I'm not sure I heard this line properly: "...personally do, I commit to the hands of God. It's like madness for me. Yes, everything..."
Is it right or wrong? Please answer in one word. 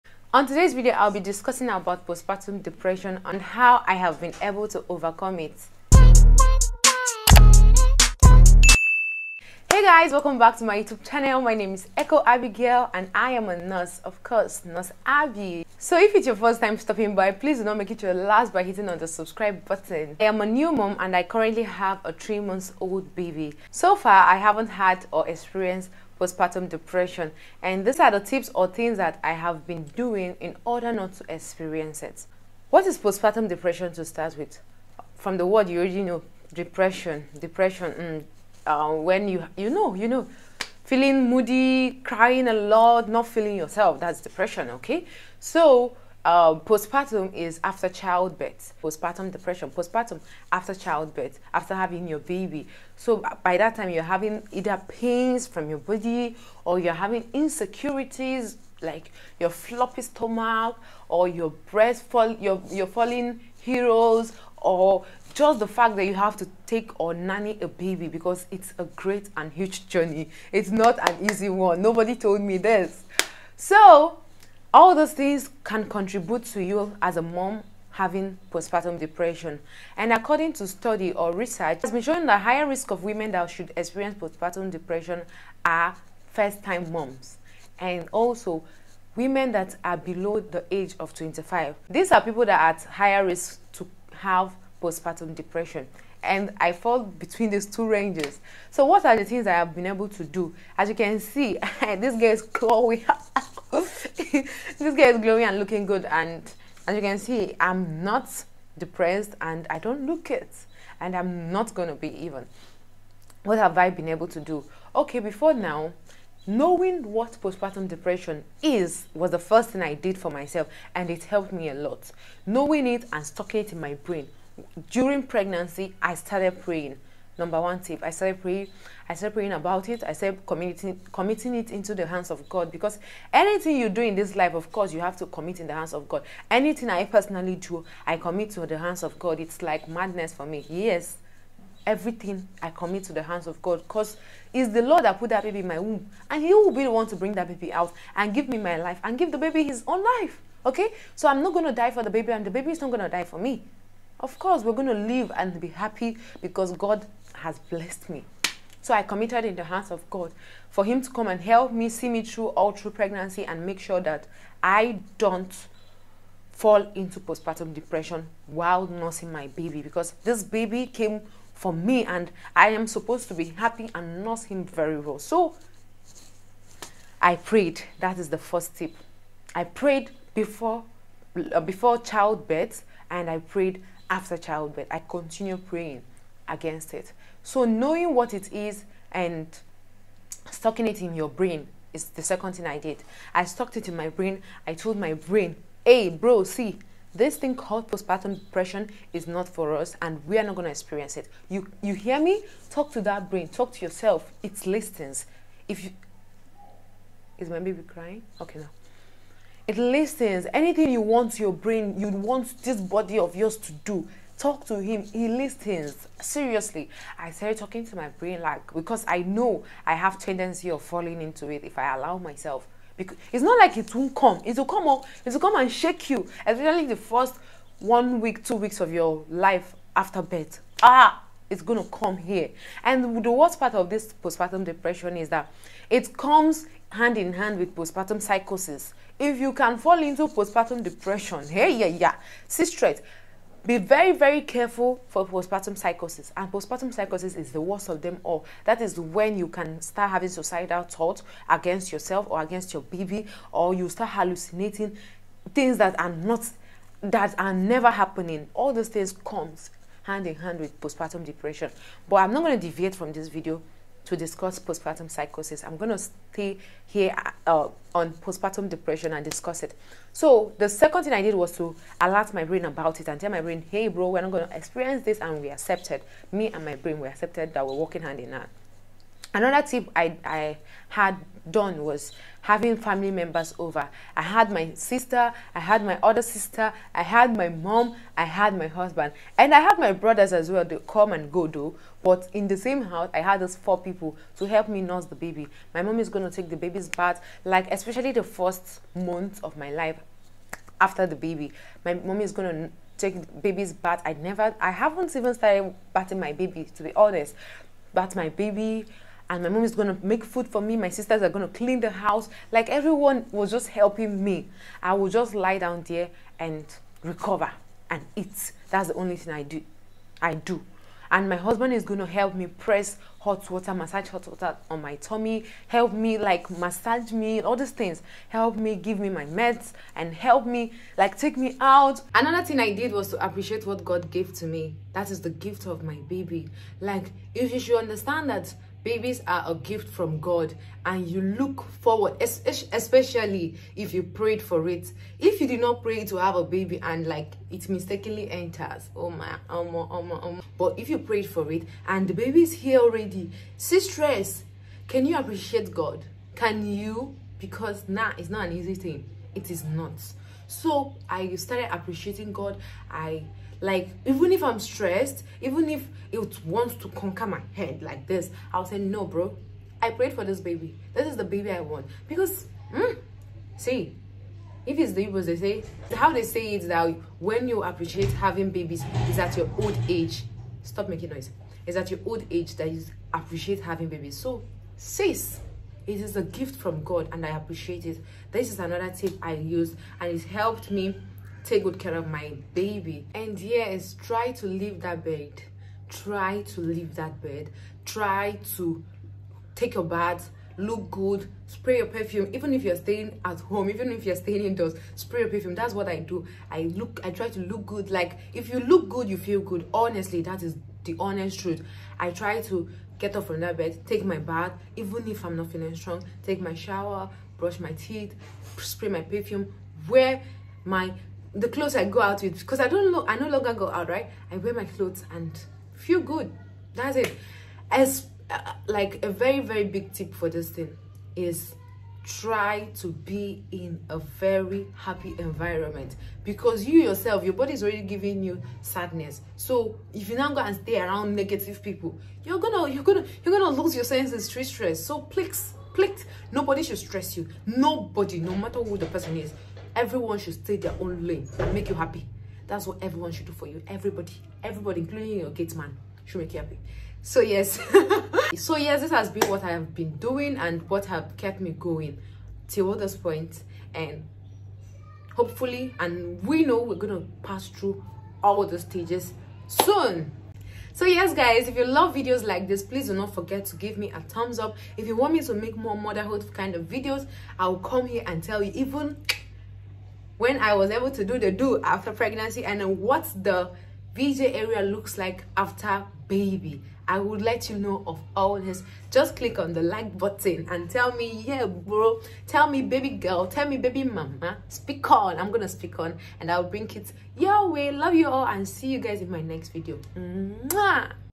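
right.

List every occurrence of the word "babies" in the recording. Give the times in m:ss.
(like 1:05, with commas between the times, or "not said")
5:38, 6:18, 6:23.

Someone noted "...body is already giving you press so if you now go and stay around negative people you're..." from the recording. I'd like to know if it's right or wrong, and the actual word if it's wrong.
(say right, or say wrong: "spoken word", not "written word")
wrong: "sadness", not "press".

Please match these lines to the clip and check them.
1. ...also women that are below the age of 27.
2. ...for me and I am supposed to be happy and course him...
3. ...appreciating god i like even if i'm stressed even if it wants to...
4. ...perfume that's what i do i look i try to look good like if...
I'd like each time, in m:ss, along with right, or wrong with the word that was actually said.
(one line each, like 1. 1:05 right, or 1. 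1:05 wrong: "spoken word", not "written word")
1. 1:28 wrong: "25", not "27"
2. 2:51 wrong: "nurse", not "course"
3. 6:01 right
4. 6:45 right.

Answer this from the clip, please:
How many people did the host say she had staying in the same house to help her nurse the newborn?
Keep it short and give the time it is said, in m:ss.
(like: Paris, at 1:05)
4, at 4:53.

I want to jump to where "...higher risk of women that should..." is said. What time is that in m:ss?
1:22.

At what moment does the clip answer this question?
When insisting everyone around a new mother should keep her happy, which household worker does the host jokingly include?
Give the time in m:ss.
7:35.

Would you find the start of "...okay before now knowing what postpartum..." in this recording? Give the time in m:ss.
1:54.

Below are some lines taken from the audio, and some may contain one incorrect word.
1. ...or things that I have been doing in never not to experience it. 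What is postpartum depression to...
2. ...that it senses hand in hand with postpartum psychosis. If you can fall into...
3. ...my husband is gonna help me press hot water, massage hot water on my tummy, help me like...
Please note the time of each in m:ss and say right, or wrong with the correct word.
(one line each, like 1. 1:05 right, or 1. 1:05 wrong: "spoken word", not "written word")
1. 0:28 wrong: "order", not "never"
2. 3:55 wrong: "comes", not "senses"
3. 5:21 right.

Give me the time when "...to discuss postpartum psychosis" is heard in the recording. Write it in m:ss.
4:24.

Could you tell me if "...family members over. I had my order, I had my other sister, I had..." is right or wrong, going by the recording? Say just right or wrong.
wrong.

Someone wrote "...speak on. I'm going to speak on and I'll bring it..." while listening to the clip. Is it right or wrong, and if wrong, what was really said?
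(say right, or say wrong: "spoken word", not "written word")
right.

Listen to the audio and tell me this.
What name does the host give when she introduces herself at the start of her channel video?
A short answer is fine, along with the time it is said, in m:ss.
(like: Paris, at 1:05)
Echo Abigail, at 0:11.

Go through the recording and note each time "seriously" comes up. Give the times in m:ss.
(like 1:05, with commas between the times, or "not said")
3:36.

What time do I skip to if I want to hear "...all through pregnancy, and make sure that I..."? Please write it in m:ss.
2:42.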